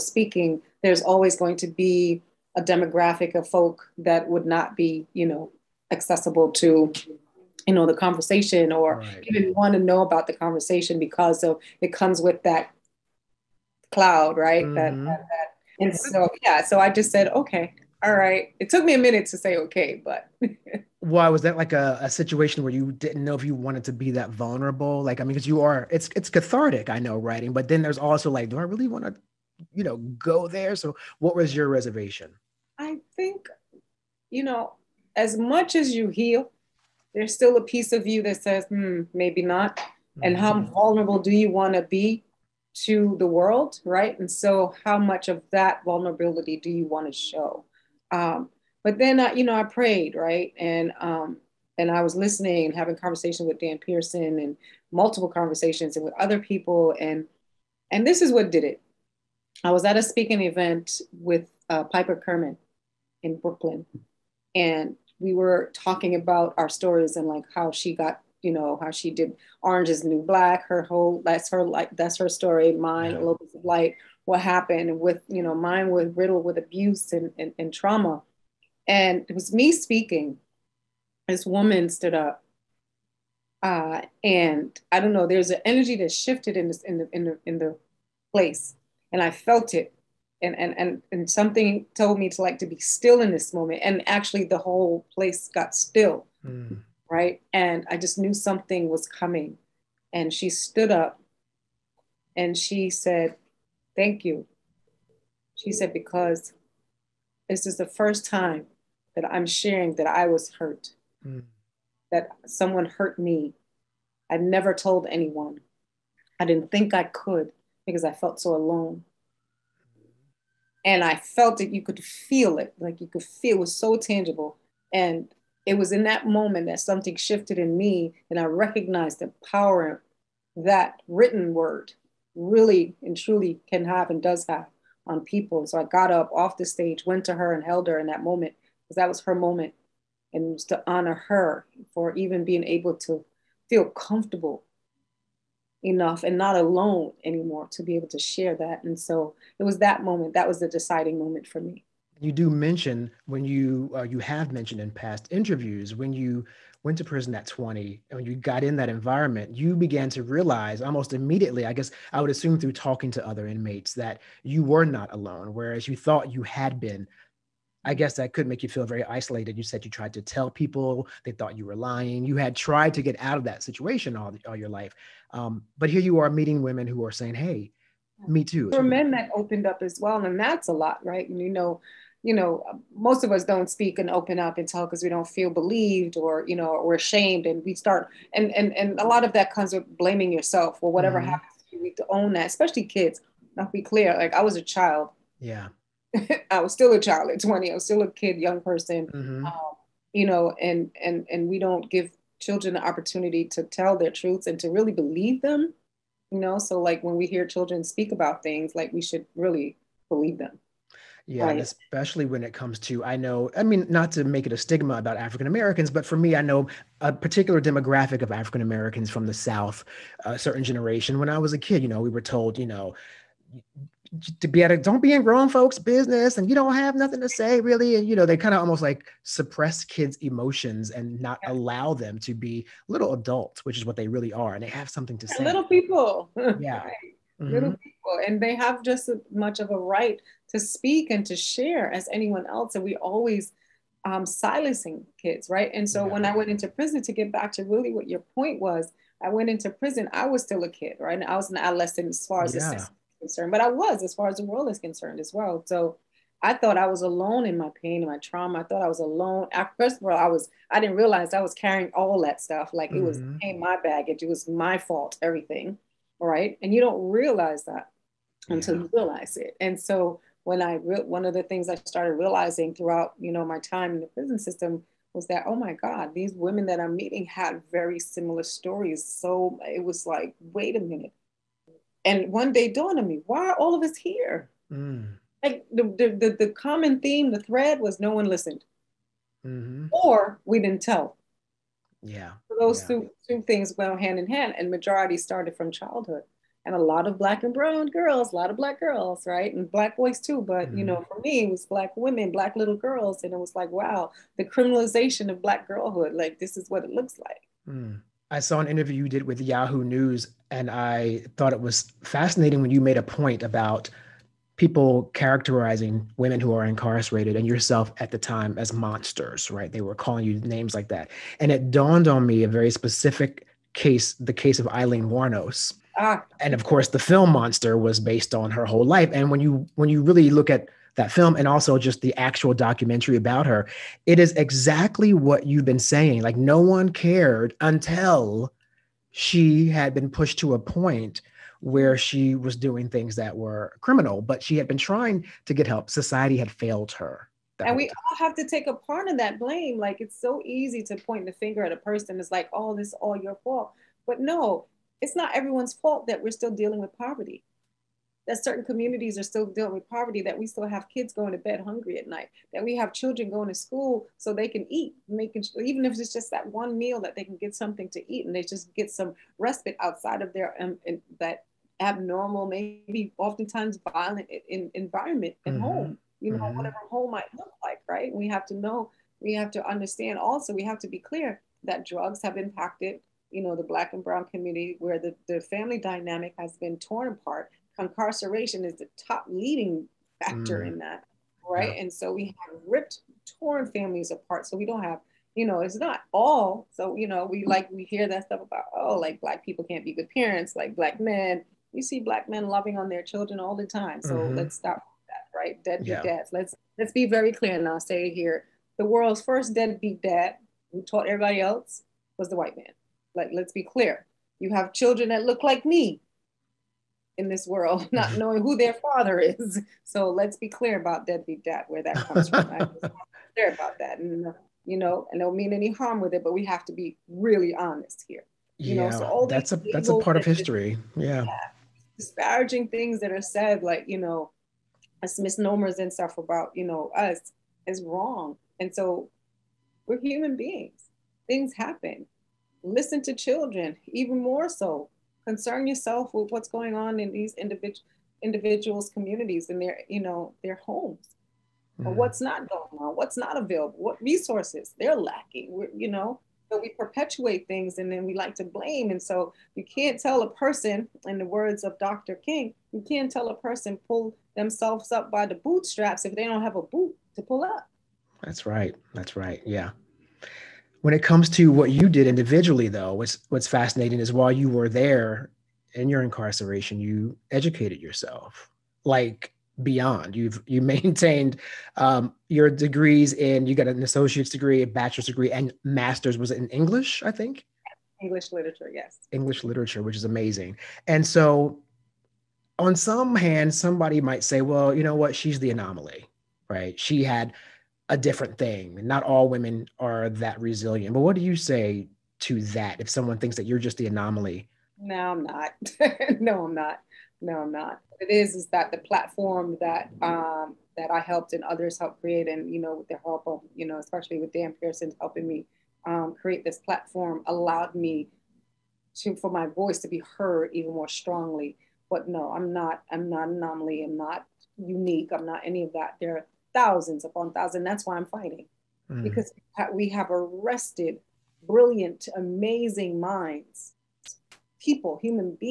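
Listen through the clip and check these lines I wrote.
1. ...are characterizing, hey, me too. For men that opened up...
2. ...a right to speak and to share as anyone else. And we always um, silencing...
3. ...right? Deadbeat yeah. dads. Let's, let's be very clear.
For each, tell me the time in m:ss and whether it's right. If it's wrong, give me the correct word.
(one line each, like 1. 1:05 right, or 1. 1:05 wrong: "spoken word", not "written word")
1. 2:57 wrong: "saying", not "characterizing"
2. 3:59 right
3. 6:45 right.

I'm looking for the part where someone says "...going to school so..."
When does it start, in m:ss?
6:03.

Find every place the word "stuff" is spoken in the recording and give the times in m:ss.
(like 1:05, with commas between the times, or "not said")
4:22, 6:38, 7:15.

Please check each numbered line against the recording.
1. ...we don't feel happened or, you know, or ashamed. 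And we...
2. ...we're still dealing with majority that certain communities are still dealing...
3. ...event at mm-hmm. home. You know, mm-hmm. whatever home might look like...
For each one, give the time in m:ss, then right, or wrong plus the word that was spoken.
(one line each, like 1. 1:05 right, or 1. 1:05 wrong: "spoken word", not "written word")
1. 3:05 wrong: "believed", not "happened"
2. 5:56 wrong: "poverty", not "majority"
3. 6:14 wrong: "environment", not "event".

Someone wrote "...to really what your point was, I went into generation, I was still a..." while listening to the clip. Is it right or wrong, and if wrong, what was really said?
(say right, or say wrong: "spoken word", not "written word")
wrong: "prison", not "generation".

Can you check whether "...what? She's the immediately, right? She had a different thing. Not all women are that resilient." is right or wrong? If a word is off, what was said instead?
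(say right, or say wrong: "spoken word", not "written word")
wrong: "anomaly", not "immediately".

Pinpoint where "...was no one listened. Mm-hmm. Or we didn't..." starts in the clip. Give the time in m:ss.
4:47.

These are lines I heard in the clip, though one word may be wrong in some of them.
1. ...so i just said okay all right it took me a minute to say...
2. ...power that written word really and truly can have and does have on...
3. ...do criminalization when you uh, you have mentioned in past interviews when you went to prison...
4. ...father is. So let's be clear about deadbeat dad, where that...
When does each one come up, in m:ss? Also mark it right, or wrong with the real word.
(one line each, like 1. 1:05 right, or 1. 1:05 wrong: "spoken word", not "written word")
1. 0:16 right
2. 2:09 right
3. 2:32 wrong: "mention", not "criminalization"
4. 6:58 right.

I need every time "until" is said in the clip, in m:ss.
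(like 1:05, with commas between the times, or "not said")
4:28, 5:37.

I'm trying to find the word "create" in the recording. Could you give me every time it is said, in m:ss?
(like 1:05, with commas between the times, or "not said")
8:32, 8:36.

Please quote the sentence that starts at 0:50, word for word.
And um, and I was listening and having conversations with Dan Pearson and multiple conversations and with other people.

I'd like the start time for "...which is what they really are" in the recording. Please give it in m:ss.
3:53.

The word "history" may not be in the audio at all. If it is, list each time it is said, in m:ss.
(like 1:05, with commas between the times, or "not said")
7:10.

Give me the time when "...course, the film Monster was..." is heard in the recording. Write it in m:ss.
5:26.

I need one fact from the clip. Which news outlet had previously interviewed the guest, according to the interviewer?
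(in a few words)
Yahoo News.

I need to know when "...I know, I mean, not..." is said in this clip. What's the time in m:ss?
3:33.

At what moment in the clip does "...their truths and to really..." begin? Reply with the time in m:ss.
3:23.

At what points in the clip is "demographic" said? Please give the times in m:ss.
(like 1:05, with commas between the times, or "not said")
0:02, 3:37.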